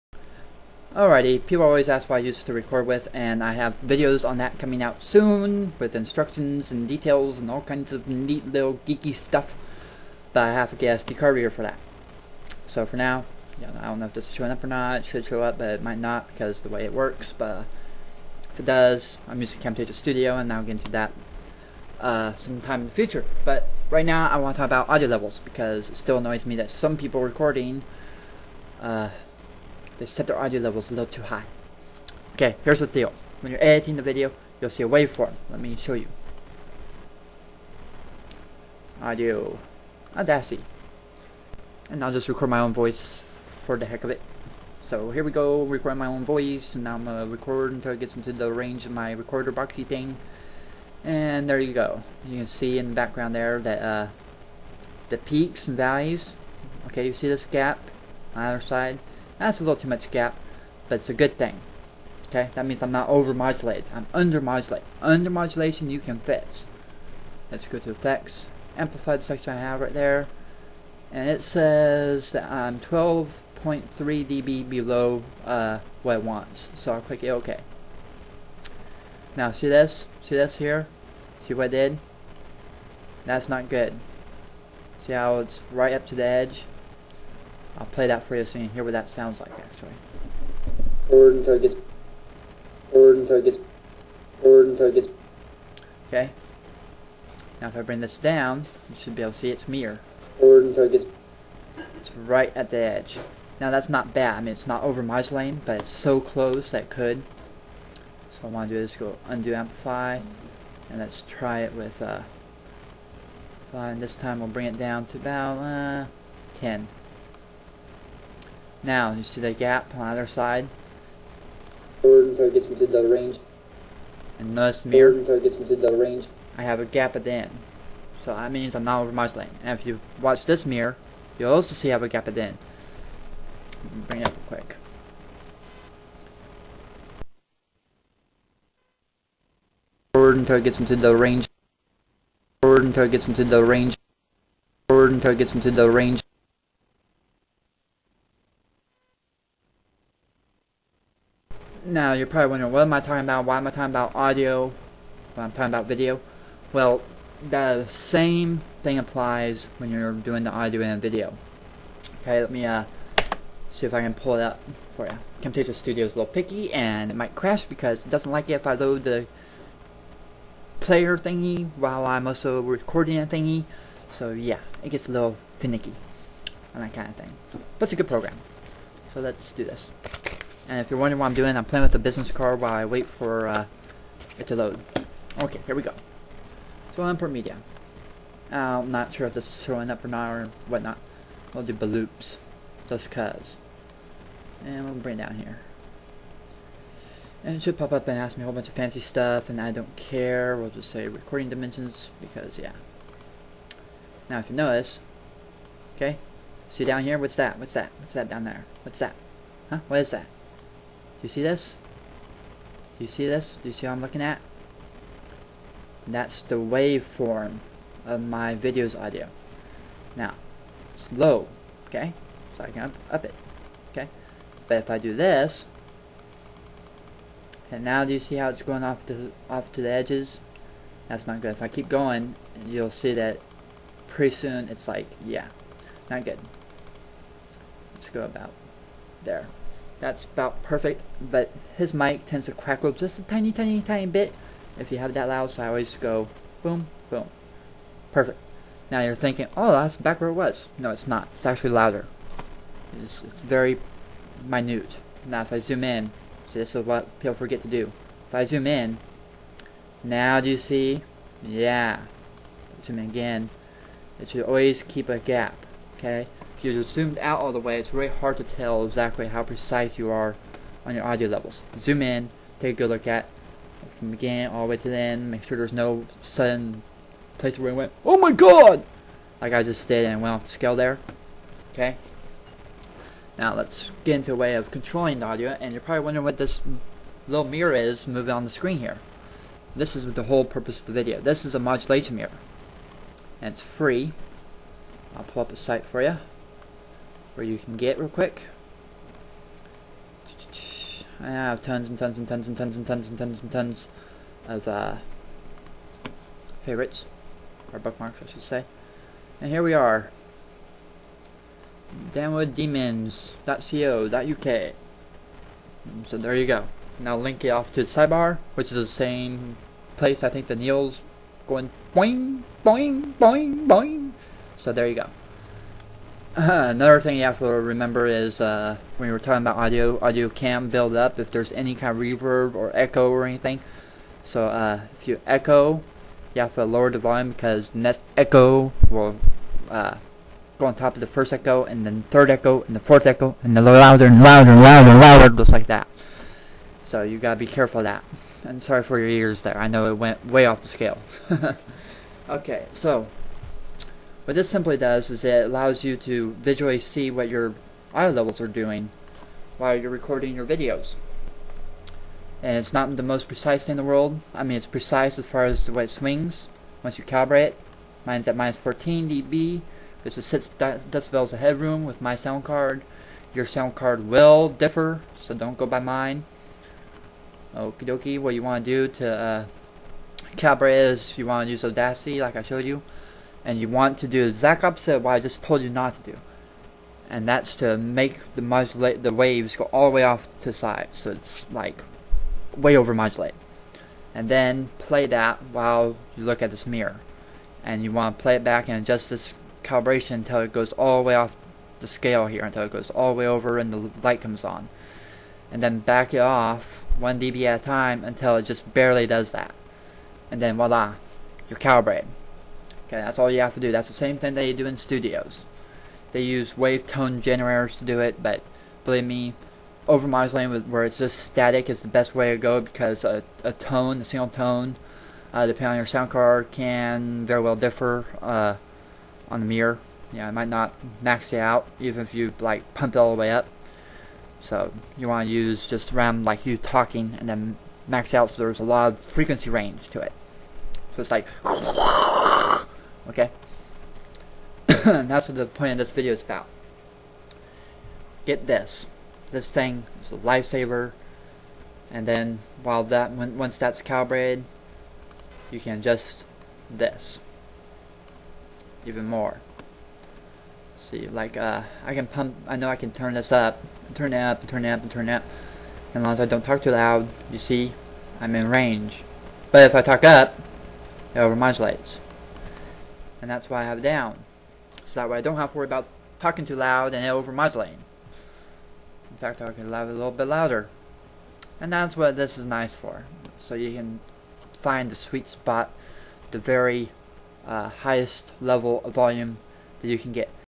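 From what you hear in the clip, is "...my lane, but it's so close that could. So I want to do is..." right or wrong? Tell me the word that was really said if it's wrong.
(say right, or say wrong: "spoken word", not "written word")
right.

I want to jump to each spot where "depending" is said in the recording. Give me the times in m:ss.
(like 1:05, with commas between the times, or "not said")
7:05.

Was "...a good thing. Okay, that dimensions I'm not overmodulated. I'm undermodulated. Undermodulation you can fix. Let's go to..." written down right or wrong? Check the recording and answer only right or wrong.
wrong.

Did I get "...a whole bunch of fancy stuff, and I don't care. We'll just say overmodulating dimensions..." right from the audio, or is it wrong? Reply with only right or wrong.
wrong.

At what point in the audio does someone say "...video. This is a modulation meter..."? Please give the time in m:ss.
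4:50.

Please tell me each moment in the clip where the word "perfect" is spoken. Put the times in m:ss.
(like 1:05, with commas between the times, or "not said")
4:00, 4:08.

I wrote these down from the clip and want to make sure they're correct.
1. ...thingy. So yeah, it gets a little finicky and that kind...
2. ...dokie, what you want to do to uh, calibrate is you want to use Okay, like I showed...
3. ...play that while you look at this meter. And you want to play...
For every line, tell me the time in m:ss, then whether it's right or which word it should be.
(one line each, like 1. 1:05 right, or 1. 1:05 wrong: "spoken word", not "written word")
1. 2:53 right
2. 6:17 wrong: "Audacity", not "Okay"
3. 6:34 right.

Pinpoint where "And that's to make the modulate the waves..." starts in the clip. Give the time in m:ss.
6:27.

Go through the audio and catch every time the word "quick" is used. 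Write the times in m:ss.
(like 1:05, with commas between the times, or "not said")
2:14, 4:58.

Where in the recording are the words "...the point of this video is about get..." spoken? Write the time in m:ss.
7:25.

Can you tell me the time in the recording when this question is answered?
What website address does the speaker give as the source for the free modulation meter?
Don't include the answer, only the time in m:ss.
5:12.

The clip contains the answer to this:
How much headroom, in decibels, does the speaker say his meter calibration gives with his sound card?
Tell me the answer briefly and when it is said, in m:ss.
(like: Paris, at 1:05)
6 decibels, at 6:10.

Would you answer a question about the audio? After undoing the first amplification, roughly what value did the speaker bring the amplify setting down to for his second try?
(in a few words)
10.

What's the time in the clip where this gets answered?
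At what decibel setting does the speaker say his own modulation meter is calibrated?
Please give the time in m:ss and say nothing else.
6:08.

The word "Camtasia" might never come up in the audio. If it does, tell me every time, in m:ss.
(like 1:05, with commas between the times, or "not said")
0:19, 2:45.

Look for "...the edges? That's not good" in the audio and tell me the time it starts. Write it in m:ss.
3:49.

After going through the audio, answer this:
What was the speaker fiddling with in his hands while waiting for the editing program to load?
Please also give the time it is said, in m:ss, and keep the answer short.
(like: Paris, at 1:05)
business card, at 3:01.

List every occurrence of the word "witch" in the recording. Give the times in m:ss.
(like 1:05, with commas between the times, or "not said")
not said.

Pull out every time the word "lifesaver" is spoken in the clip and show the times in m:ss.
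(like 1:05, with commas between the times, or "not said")
7:30.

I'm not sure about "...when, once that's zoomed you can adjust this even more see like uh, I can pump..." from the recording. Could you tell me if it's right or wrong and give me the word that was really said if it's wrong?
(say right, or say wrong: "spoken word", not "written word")
wrong: "calibrated", not "zoomed".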